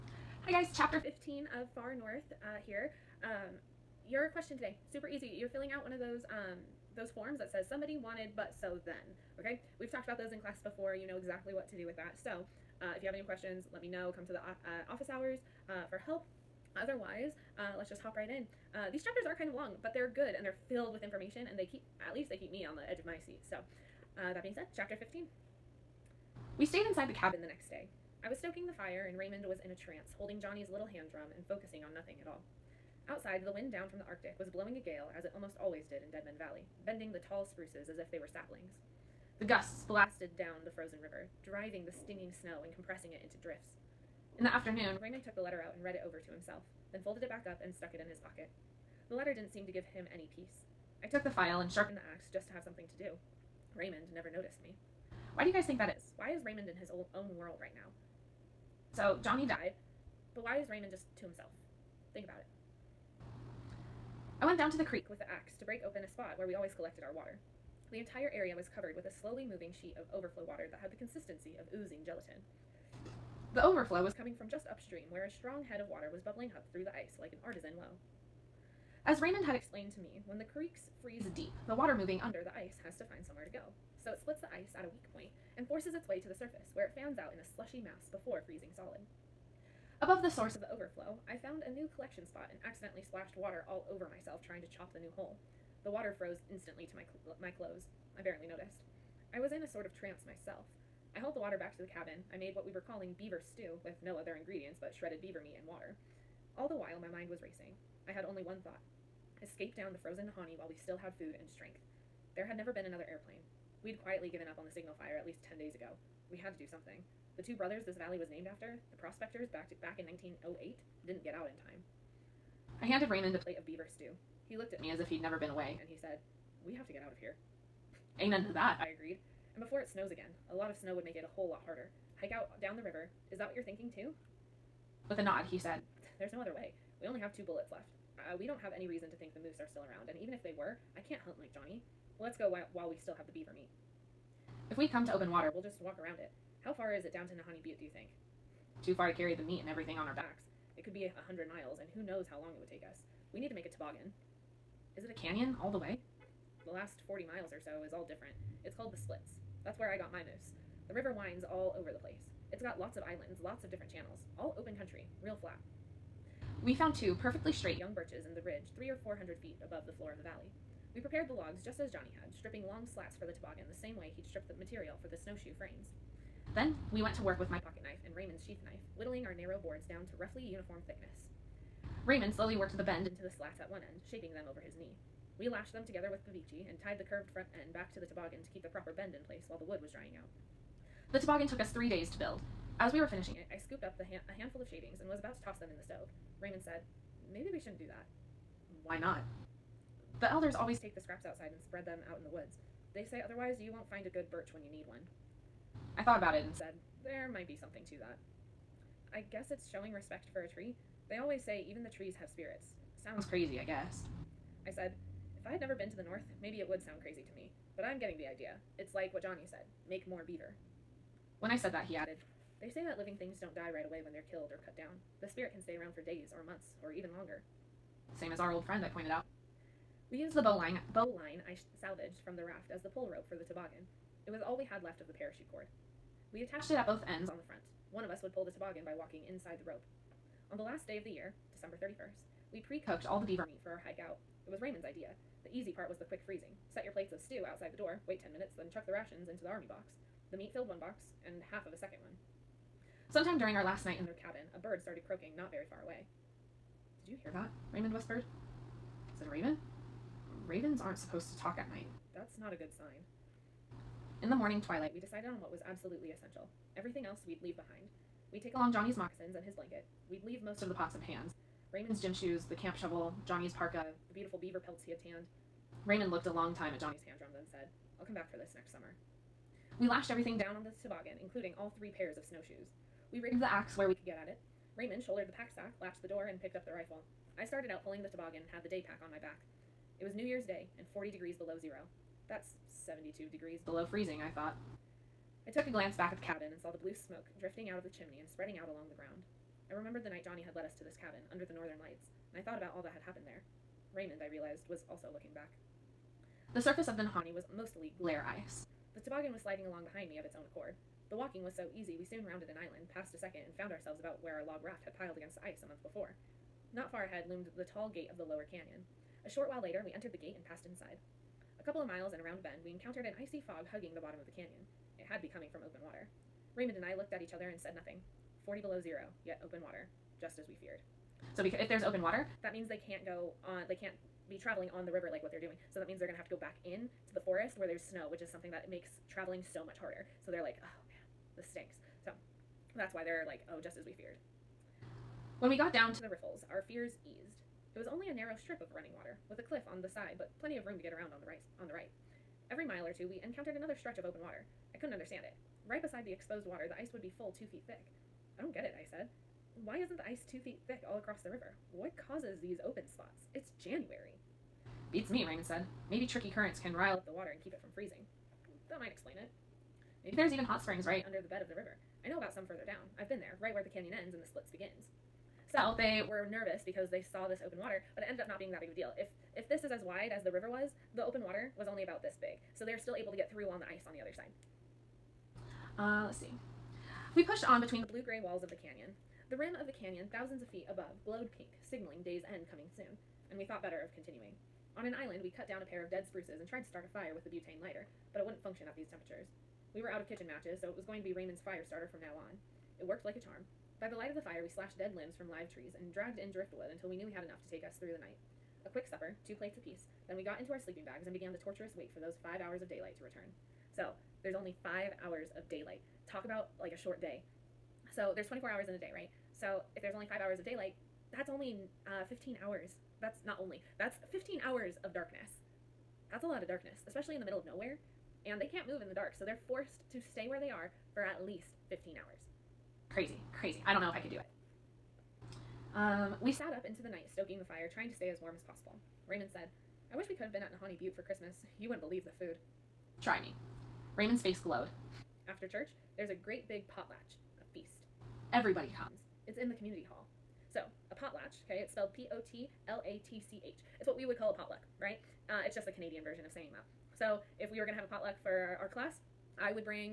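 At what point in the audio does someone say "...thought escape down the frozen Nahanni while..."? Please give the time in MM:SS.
01:48.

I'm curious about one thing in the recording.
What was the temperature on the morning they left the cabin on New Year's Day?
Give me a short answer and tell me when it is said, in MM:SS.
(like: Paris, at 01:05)
40 below zero, at 04:50.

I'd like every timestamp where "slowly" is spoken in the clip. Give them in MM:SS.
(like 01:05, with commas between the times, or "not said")
01:09, 03:02.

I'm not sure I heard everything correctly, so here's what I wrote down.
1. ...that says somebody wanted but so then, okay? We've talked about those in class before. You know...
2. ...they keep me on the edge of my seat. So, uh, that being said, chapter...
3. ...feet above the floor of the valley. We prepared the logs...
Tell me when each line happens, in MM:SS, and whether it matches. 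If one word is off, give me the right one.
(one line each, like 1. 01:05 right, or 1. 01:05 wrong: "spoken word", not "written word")
1. 00:07 right
2. 00:22 right
3. 02:49 right.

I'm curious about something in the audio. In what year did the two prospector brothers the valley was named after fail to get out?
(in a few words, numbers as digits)
1908.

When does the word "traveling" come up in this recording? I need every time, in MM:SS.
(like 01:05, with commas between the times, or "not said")
05:34, 05:39.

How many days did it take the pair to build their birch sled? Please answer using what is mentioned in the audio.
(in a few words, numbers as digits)
3.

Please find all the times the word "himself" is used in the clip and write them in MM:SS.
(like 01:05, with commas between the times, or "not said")
00:46, 01:01.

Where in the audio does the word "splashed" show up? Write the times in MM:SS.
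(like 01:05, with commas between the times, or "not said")
01:33.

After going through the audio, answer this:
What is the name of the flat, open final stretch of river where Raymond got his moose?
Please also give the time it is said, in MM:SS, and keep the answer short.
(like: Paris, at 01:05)
the Split, at 02:38.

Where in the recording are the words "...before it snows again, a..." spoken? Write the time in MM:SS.
02:09.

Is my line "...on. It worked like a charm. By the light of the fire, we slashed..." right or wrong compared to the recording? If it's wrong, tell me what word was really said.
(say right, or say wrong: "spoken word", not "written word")
right.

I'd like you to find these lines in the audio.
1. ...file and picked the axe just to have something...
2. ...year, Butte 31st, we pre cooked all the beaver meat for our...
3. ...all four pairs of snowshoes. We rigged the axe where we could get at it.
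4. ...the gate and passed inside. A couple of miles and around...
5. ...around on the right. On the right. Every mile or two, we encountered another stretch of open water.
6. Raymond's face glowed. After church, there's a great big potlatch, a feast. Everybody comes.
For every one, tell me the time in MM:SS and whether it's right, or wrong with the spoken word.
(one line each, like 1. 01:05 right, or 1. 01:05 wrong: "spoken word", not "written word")
1. 00:51 wrong: "sharpened", not "picked"
2. 04:01 wrong: "December", not "Butte"
3. 04:41 wrong: "three", not "four"
4. 05:20 right
5. 05:50 right
6. 07:23 right.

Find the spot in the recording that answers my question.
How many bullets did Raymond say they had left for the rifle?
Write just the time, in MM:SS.
02:17.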